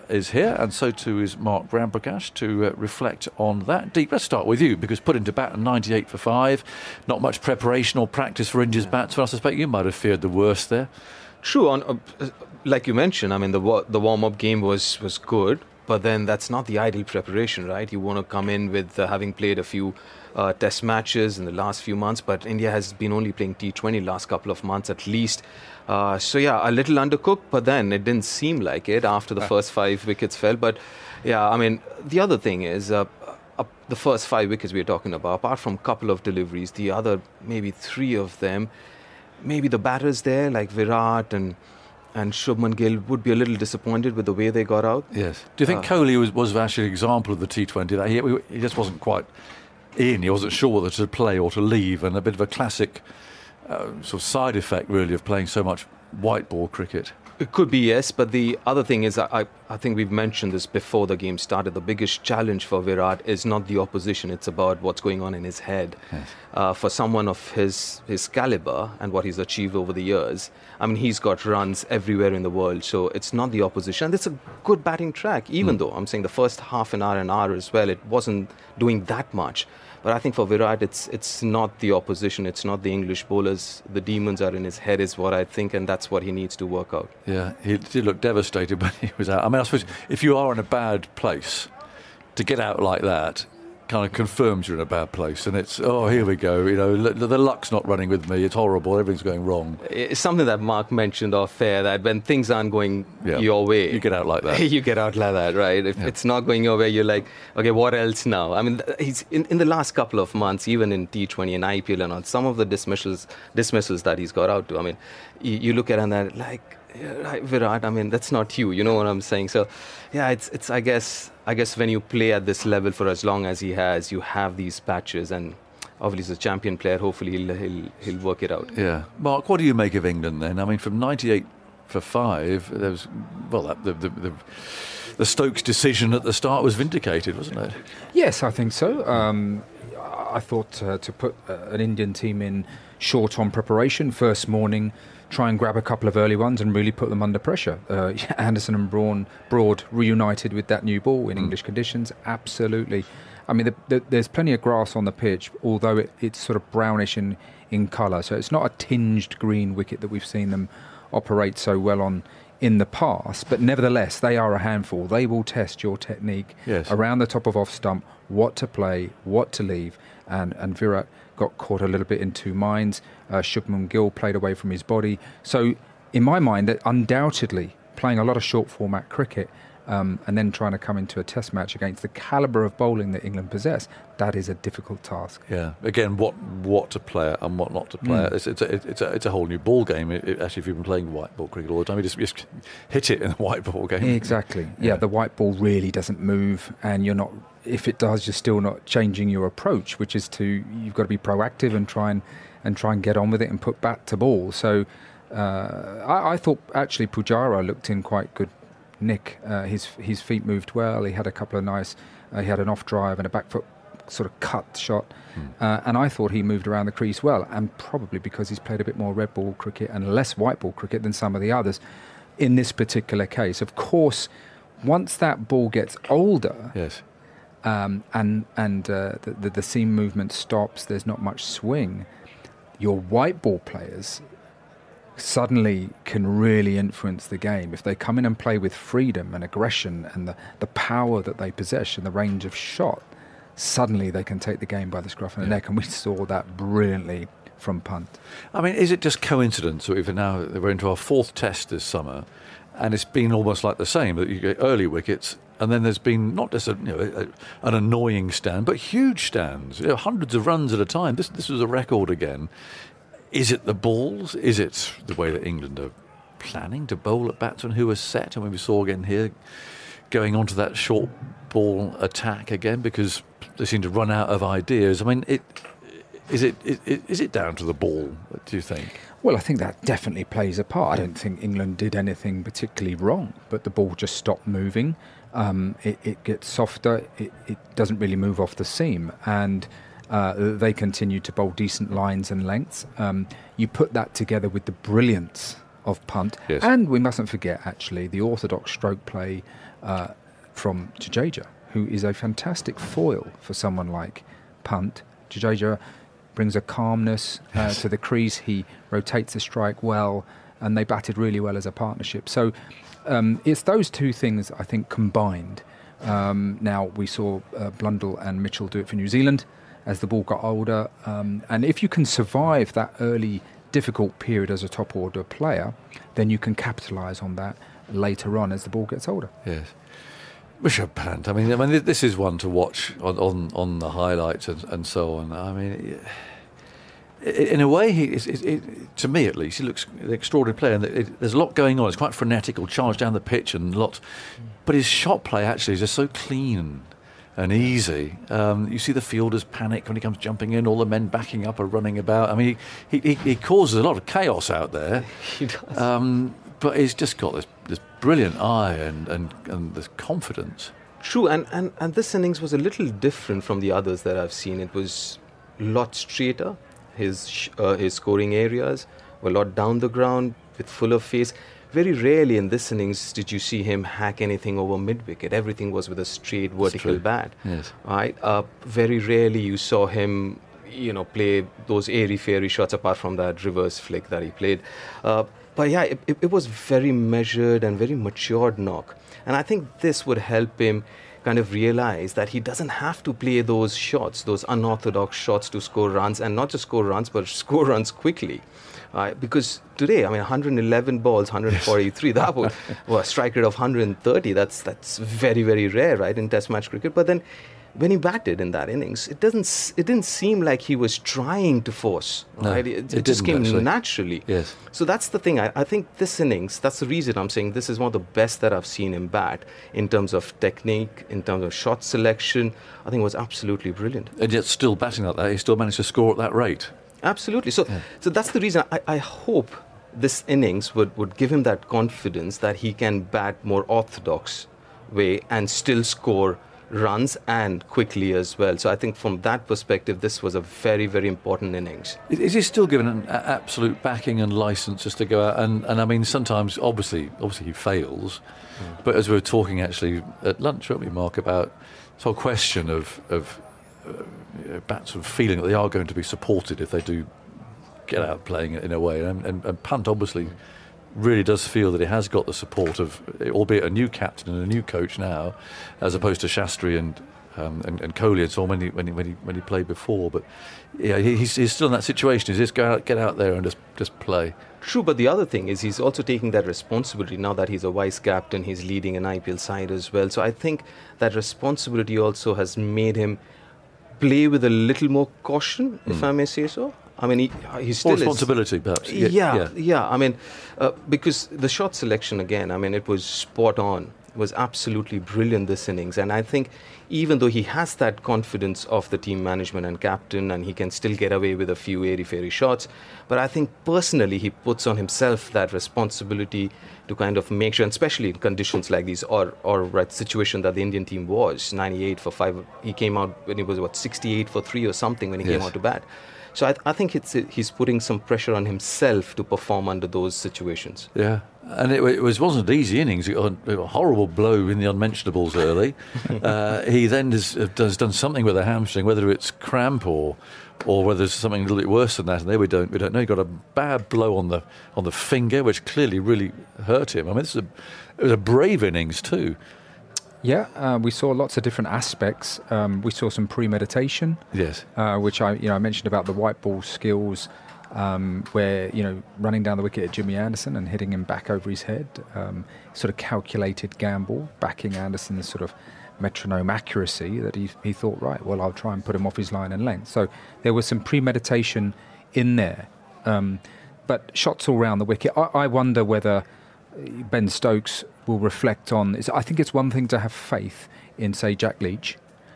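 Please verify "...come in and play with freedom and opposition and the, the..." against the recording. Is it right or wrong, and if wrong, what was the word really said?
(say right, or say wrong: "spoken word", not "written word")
wrong: "aggression", not "opposition".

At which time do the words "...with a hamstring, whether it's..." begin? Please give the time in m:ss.
8:48.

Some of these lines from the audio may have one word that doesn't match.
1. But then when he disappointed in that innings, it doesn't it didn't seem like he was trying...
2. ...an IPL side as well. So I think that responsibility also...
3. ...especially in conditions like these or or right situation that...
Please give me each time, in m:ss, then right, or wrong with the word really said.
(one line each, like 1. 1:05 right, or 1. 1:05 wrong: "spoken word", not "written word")
1. 6:46 wrong: "batted", not "disappointed"
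2. 7:58 right
3. 8:27 right.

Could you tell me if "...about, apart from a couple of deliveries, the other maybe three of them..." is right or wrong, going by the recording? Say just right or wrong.
right.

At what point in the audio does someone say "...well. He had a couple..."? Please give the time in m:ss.
3:30.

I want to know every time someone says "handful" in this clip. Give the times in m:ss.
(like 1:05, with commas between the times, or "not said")
2:44.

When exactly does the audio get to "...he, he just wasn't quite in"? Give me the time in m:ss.
0:48.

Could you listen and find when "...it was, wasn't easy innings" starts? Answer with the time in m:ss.
8:41.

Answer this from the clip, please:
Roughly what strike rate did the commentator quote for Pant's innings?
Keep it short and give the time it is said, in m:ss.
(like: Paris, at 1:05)
130, at 6:43.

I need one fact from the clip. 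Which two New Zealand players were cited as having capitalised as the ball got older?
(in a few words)
Blundell and Mitchell.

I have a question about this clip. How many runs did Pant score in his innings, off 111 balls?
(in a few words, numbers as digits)
143.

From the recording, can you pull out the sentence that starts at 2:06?
Hopefully he'll he'll he'll work it out.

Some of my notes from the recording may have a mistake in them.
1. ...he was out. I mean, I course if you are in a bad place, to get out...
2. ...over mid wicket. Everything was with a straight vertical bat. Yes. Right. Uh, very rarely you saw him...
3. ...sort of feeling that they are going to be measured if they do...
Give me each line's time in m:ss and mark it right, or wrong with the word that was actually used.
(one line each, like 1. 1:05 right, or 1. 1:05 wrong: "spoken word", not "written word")
1. 1:29 wrong: "suppose", not "course"
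2. 6:14 right
3. 7:34 wrong: "supported", not "measured".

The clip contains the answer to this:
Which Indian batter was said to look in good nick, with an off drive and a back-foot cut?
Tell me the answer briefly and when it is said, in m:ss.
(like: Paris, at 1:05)
Pujara, at 3:27.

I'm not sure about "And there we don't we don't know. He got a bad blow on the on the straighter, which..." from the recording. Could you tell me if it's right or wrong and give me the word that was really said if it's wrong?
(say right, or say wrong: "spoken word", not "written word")
wrong: "finger", not "straighter".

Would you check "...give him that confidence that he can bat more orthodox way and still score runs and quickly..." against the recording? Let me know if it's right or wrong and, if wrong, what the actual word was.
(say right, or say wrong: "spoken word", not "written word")
right.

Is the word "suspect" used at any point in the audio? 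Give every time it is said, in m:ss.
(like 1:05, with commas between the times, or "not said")
0:09.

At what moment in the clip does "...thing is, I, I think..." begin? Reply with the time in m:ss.
0:58.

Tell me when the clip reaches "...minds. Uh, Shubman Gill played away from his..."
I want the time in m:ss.
2:52.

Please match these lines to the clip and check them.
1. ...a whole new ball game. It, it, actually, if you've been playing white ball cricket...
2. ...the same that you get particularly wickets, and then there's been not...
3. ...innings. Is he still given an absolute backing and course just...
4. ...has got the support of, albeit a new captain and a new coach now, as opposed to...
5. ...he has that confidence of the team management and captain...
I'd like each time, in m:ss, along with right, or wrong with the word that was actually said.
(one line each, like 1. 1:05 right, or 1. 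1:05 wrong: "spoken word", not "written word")
1. 3:09 right
2. 4:13 wrong: "early", not "particularly"
3. 7:21 wrong: "license", not "course"
4. 7:41 right
5. 8:17 right.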